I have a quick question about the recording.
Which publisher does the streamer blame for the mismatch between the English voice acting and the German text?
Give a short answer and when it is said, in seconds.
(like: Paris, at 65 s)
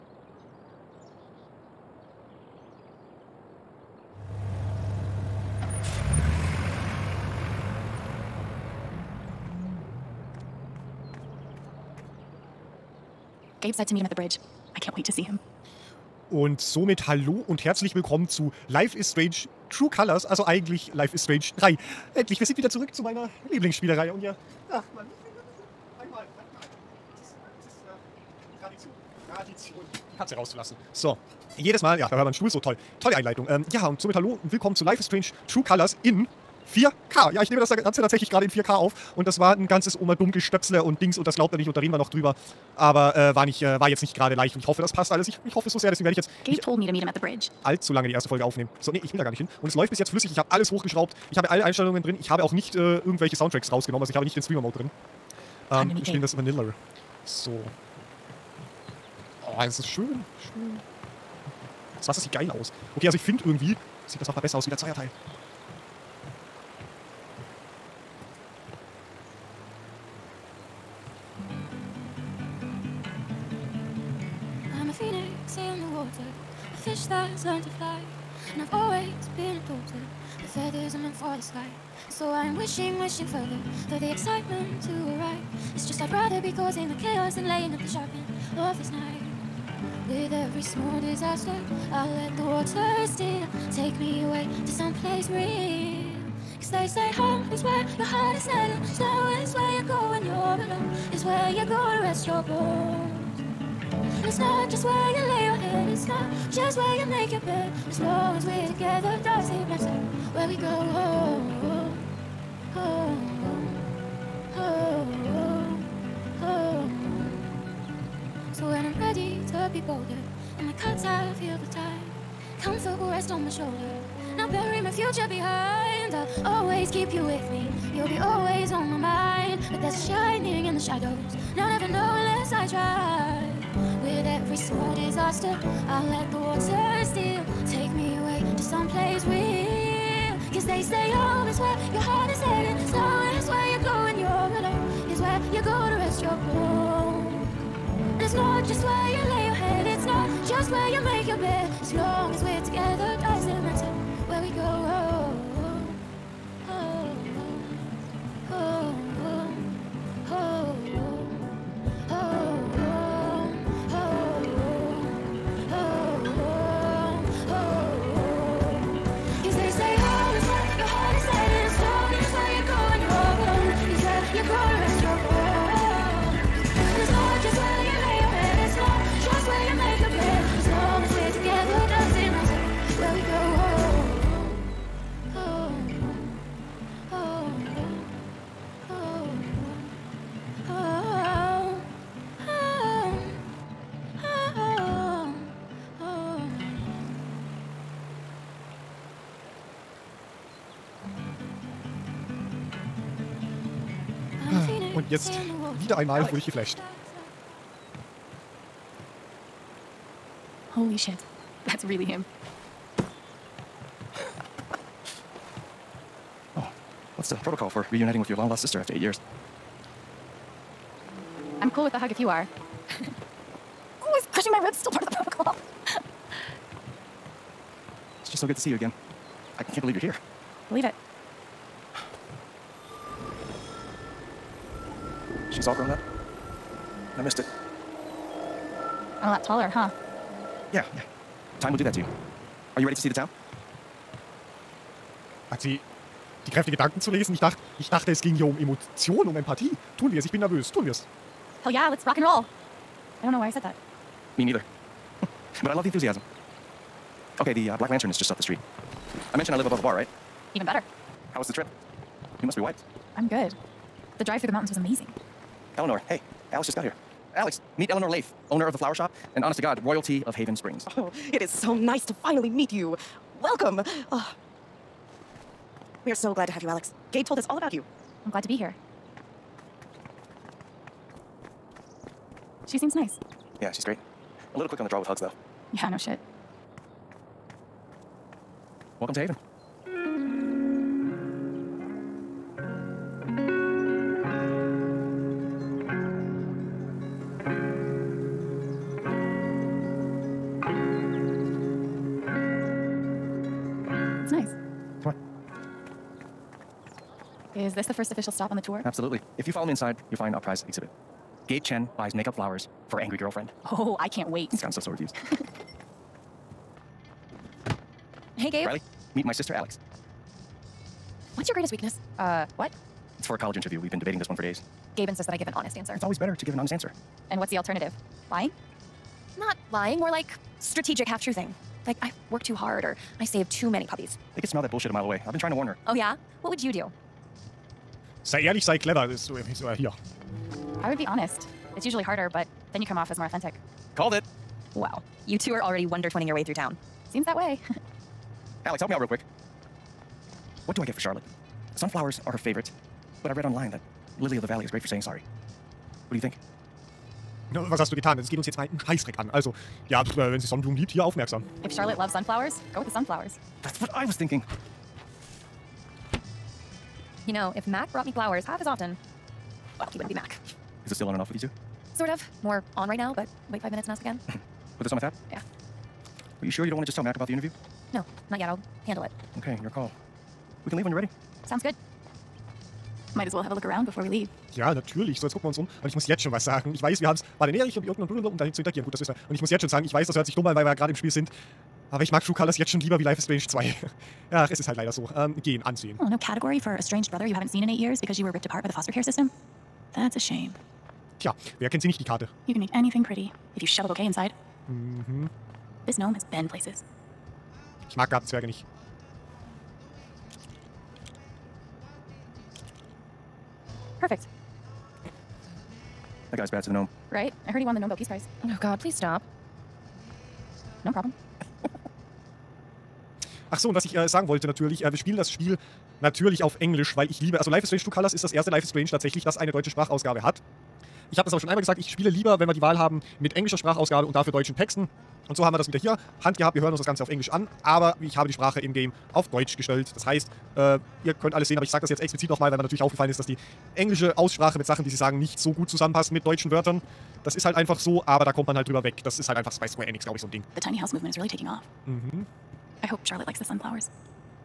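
Square Enix, at 449 s.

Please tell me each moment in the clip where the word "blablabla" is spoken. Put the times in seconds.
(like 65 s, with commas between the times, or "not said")
388 s.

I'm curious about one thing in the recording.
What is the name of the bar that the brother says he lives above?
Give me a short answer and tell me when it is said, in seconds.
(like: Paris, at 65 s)
Black Lantern, at 257 s.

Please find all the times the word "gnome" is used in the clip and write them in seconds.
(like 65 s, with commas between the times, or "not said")
405 s, 416 s.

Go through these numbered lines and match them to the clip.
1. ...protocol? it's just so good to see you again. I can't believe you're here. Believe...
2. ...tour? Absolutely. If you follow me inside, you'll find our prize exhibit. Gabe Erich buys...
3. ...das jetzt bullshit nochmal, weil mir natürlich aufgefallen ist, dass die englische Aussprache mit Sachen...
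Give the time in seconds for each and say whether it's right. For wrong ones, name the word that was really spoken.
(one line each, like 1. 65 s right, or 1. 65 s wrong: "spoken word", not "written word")
1. 225 s right
2. 308 s wrong: "Chen", not "Erich"
3. 441 s wrong: "explizit", not "bullshit".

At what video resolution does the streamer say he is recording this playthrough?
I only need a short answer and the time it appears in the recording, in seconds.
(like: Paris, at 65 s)
4K, at 38 s.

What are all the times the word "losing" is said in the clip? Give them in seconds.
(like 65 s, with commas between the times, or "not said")
not said.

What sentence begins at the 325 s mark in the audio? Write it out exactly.
It's always better to give an honest answer.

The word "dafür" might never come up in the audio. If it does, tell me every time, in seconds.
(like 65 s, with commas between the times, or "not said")
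434 s.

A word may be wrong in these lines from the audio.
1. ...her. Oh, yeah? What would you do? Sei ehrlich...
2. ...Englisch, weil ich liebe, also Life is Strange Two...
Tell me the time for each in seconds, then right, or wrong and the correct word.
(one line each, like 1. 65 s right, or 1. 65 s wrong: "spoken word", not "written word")
1. 335 s right
2. 426 s right.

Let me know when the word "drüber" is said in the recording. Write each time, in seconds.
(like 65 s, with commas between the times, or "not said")
42 s, 448 s.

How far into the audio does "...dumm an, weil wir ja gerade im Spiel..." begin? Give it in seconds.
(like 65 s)
390 s.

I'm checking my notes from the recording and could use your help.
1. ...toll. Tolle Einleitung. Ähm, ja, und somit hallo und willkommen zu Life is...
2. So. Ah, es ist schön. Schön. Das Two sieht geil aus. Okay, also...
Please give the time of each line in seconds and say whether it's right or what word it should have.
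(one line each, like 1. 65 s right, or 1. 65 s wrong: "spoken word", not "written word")
1. 32 s right
2. 57 s wrong: "Wasser", not "Two".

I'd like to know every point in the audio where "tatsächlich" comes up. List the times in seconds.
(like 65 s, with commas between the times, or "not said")
38 s, 428 s.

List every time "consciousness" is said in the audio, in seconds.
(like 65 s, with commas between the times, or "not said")
not said.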